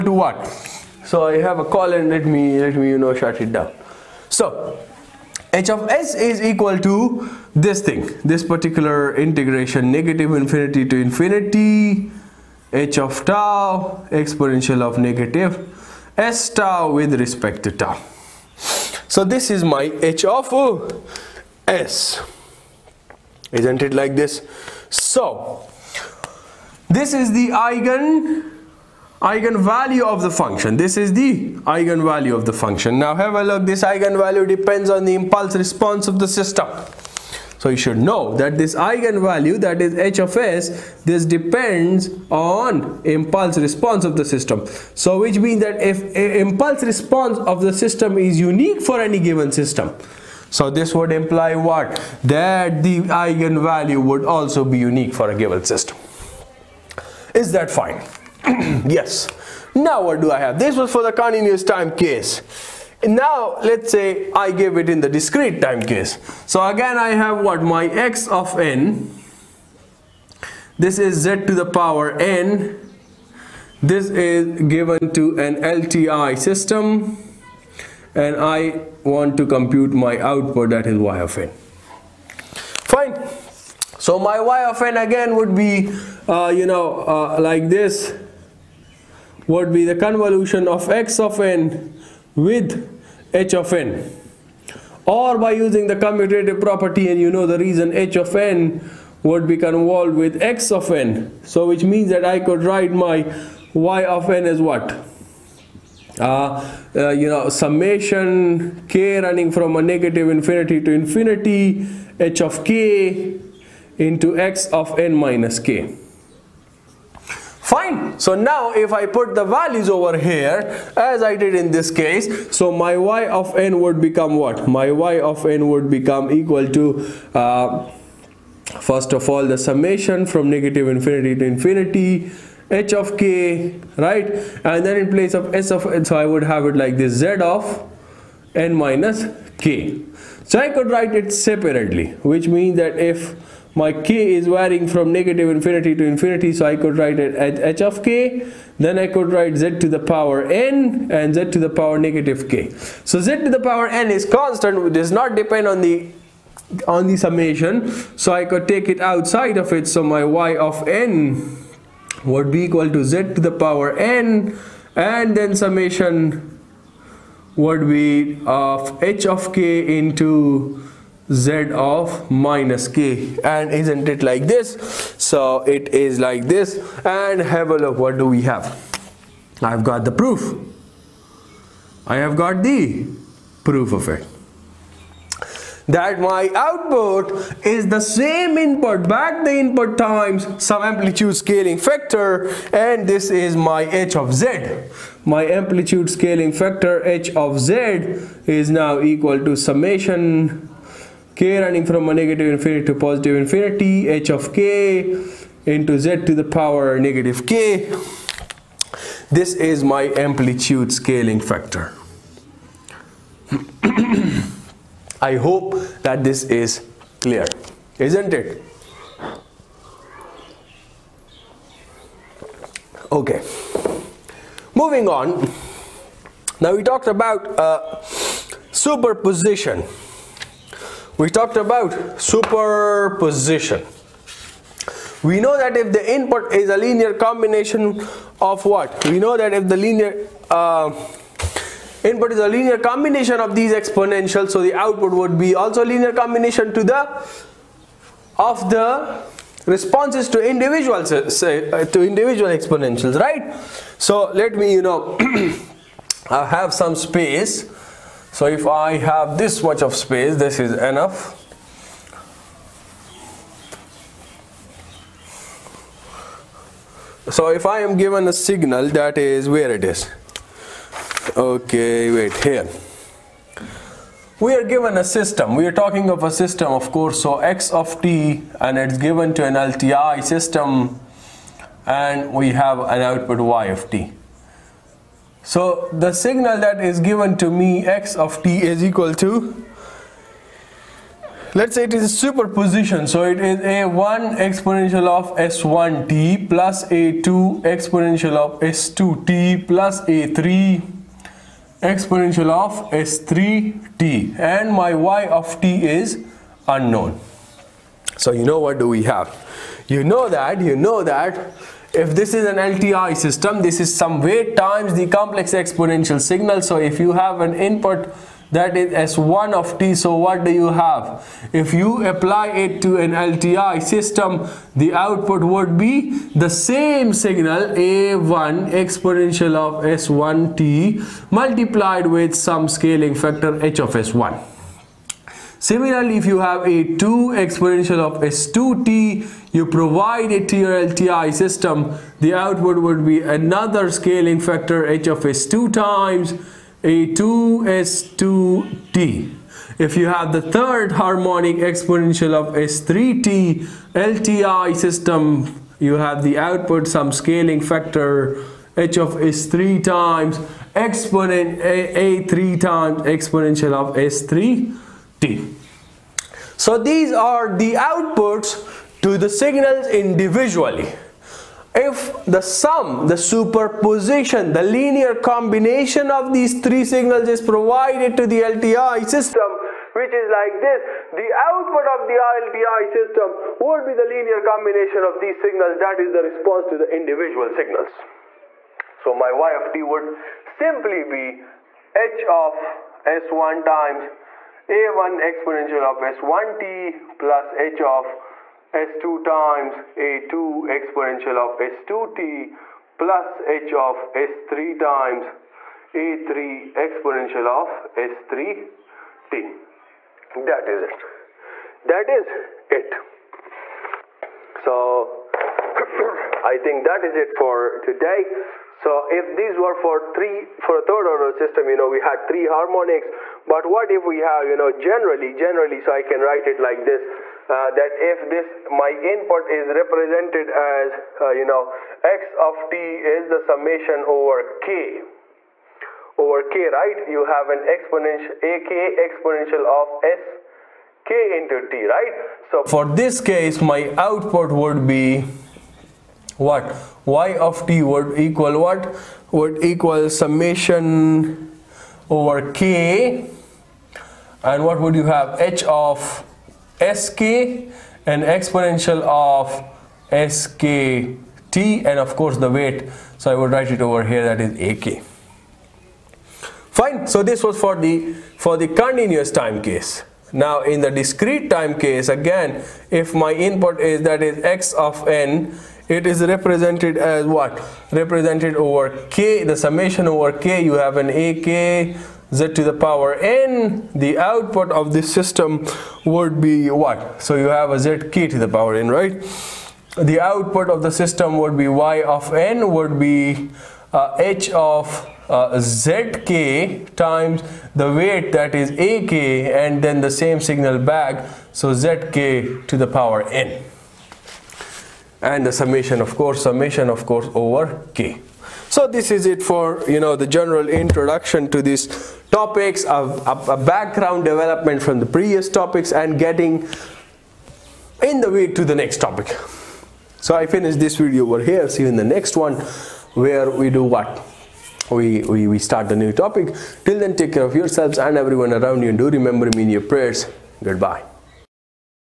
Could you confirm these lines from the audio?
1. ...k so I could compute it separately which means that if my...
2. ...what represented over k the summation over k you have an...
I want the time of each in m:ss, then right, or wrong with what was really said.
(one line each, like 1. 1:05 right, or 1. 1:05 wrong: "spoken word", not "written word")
1. 2:19 wrong: "write", not "compute"
2. 7:57 right.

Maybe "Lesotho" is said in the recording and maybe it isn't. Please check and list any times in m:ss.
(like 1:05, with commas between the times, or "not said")
not said.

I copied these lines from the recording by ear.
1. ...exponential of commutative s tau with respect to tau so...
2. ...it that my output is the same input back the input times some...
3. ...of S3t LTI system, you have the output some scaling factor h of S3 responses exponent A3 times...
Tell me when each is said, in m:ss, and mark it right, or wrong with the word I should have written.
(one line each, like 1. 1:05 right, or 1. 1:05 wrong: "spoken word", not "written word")
1. 0:14 wrong: "negative", not "commutative"
2. 3:04 right
3. 5:52 wrong: "times", not "responses".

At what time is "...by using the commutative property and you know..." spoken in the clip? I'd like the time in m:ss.
1:35.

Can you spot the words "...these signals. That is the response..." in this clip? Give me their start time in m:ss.
6:25.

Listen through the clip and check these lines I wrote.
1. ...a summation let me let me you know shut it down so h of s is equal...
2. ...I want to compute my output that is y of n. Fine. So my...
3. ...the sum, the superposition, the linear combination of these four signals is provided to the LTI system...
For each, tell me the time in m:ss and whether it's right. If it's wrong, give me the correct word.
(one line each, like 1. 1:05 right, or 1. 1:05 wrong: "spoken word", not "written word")
1. 0:01 wrong: "colon", not "summation"
2. 1:18 right
3. 6:12 wrong: "three", not "four".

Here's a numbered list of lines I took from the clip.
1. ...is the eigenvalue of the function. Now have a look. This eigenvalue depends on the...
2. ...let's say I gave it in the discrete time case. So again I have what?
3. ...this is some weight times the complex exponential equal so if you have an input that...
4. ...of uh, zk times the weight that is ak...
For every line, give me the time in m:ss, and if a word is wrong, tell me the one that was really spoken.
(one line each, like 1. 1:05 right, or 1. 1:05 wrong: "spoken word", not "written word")
1. 0:30 right
2. 1:03 right
3. 5:13 wrong: "signal", not "equal"
4. 8:14 right.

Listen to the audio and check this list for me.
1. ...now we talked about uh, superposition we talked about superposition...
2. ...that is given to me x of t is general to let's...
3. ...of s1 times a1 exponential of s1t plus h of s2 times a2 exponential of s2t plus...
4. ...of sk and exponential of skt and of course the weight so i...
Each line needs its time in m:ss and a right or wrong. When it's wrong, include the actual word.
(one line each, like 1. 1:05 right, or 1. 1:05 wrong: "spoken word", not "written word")
1. 3:46 right
2. 4:46 wrong: "equal", not "general"
3. 6:32 right
4. 7:35 right.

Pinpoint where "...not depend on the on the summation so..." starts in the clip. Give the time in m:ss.
2:35.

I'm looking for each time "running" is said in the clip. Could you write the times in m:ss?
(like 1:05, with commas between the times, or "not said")
1:49, 3:21.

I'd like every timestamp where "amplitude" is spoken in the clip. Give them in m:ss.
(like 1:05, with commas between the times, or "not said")
3:10, 3:15, 3:30.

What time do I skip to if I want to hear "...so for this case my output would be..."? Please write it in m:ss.
7:22.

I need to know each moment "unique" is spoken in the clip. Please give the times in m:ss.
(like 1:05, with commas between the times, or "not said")
0:48, 0:54.